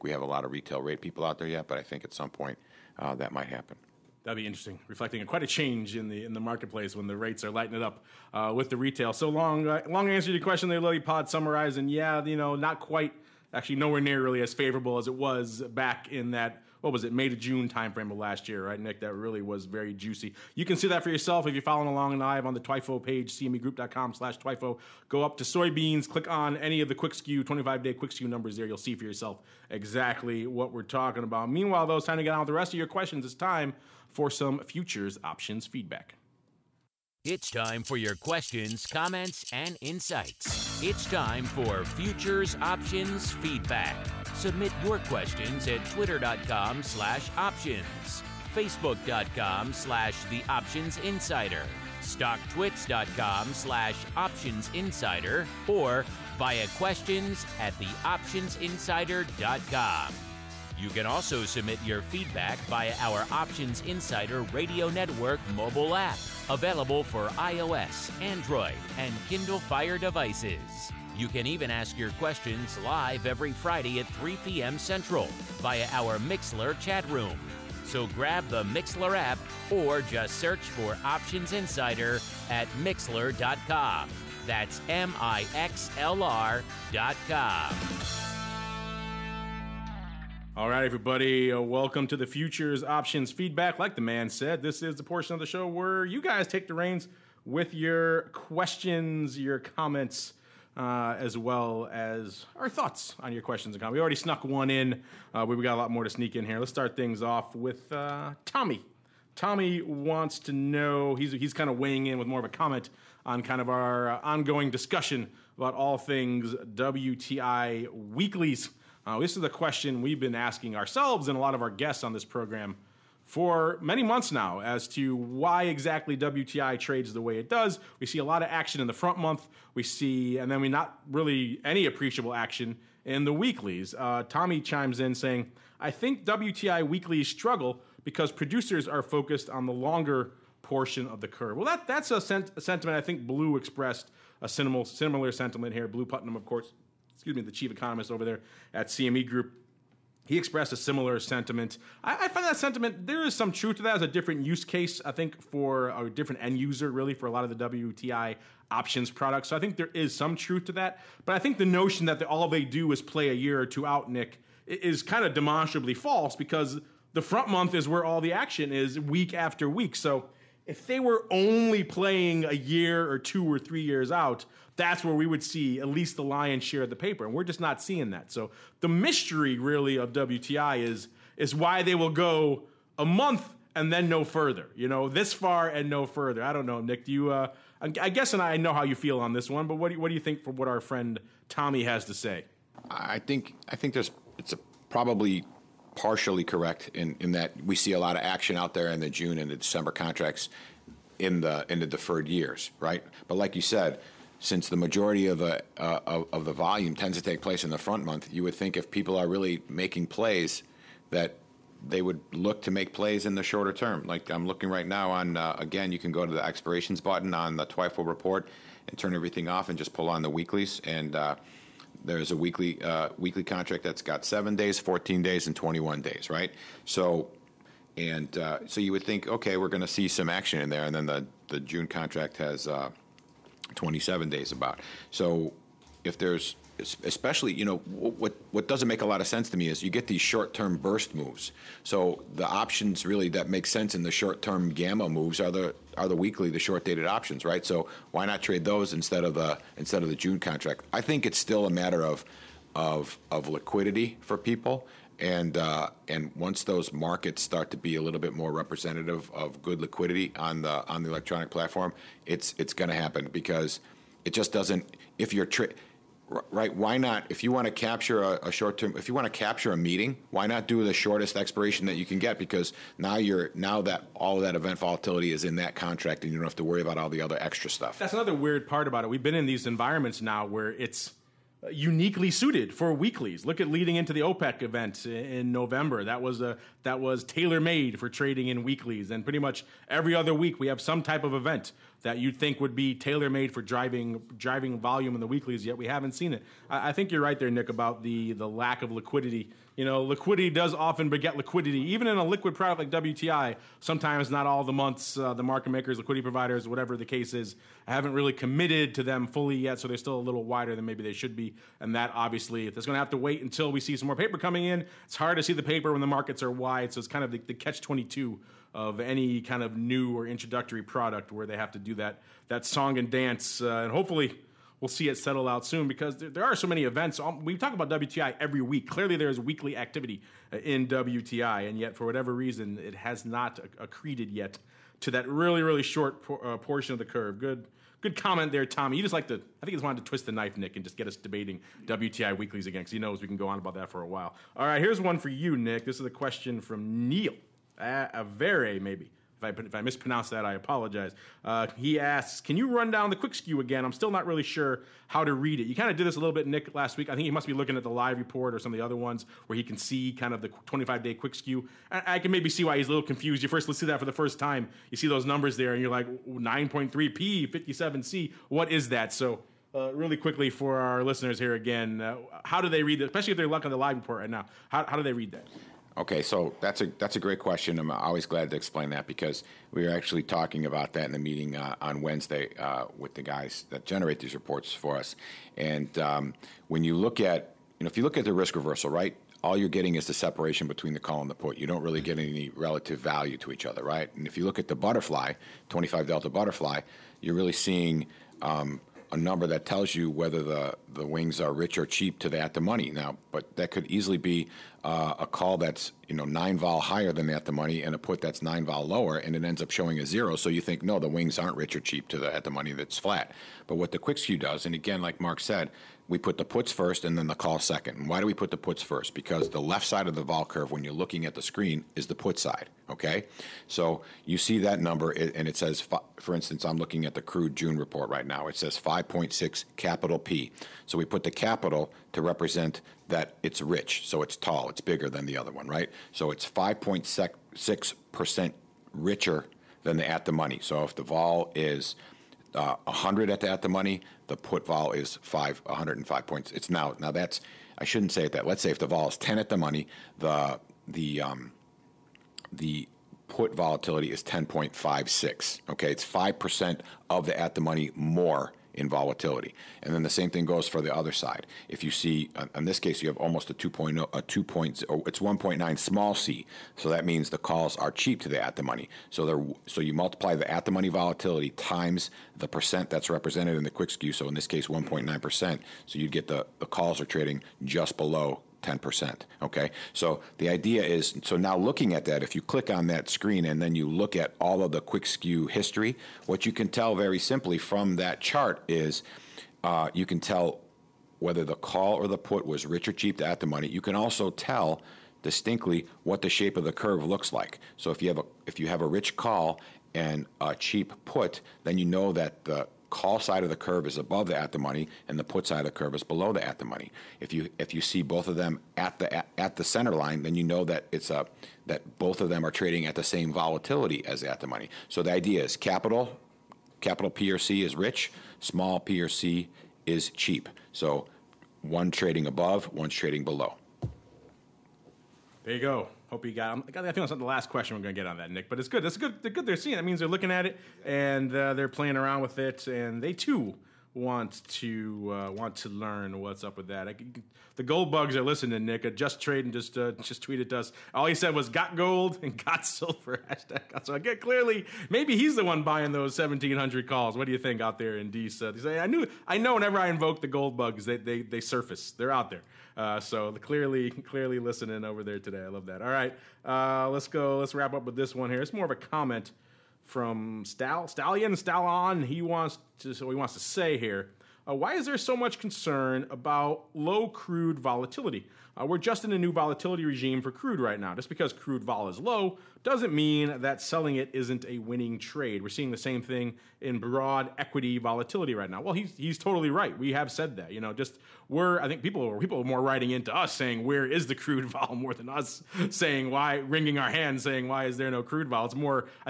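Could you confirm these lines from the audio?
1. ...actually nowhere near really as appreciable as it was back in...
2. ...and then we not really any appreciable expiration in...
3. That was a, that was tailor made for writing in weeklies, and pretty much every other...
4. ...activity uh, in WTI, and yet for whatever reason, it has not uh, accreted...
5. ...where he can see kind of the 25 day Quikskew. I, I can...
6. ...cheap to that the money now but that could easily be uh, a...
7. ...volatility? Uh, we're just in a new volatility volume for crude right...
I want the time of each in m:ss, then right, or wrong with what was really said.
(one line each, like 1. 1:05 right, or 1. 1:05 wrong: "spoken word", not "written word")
1. 0:13 wrong: "favorable", not "appreciable"
2. 2:10 wrong: "action", not "expiration"
3. 4:46 wrong: "trading", not "writing"
4. 5:29 right
5. 5:59 right
6. 6:41 right
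7. 9:27 wrong: "regime", not "volume".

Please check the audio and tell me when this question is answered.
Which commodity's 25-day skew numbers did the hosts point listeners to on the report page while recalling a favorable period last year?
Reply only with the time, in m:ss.
0:25.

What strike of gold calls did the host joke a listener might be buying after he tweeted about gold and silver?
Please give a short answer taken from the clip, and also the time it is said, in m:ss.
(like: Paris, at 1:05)
1700, at 9:06.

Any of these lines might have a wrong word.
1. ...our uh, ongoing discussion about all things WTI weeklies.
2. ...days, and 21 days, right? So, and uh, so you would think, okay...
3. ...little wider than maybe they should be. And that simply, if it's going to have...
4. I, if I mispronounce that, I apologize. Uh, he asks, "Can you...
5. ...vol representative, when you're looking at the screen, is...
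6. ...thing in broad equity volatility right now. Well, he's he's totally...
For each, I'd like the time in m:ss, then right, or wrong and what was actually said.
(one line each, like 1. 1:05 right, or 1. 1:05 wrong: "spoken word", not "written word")
1. 1:53 right
2. 3:45 right
3. 5:10 wrong: "obviously", not "simply"
4. 5:49 right
5. 7:00 wrong: "curve", not "representative"
6. 9:36 right.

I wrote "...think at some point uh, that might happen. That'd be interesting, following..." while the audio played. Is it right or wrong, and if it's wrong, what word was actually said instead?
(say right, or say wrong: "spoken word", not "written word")
wrong: "reflecting", not "following".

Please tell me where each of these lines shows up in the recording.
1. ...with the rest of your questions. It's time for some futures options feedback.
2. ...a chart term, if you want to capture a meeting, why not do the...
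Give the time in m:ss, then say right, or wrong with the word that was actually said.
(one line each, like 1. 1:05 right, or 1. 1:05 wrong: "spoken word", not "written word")
1. 0:32 right
2. 4:28 wrong: "short", not "chart".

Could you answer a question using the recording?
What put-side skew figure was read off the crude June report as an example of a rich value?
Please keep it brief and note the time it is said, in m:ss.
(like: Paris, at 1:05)
5.6 P, at 7:08.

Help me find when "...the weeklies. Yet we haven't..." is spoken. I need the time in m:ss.
4:55.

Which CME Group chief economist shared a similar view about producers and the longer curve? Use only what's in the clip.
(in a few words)
Blu Putnam.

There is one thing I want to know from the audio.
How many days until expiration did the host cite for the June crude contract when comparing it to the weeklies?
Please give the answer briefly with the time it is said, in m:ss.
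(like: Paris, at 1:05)
27, at 3:53.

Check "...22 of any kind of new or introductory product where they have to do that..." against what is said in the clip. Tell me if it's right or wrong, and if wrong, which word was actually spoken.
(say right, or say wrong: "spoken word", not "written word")
right.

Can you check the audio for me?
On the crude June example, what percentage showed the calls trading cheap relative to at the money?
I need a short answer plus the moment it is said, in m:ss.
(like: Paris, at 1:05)
1.9 percent, at 7:45.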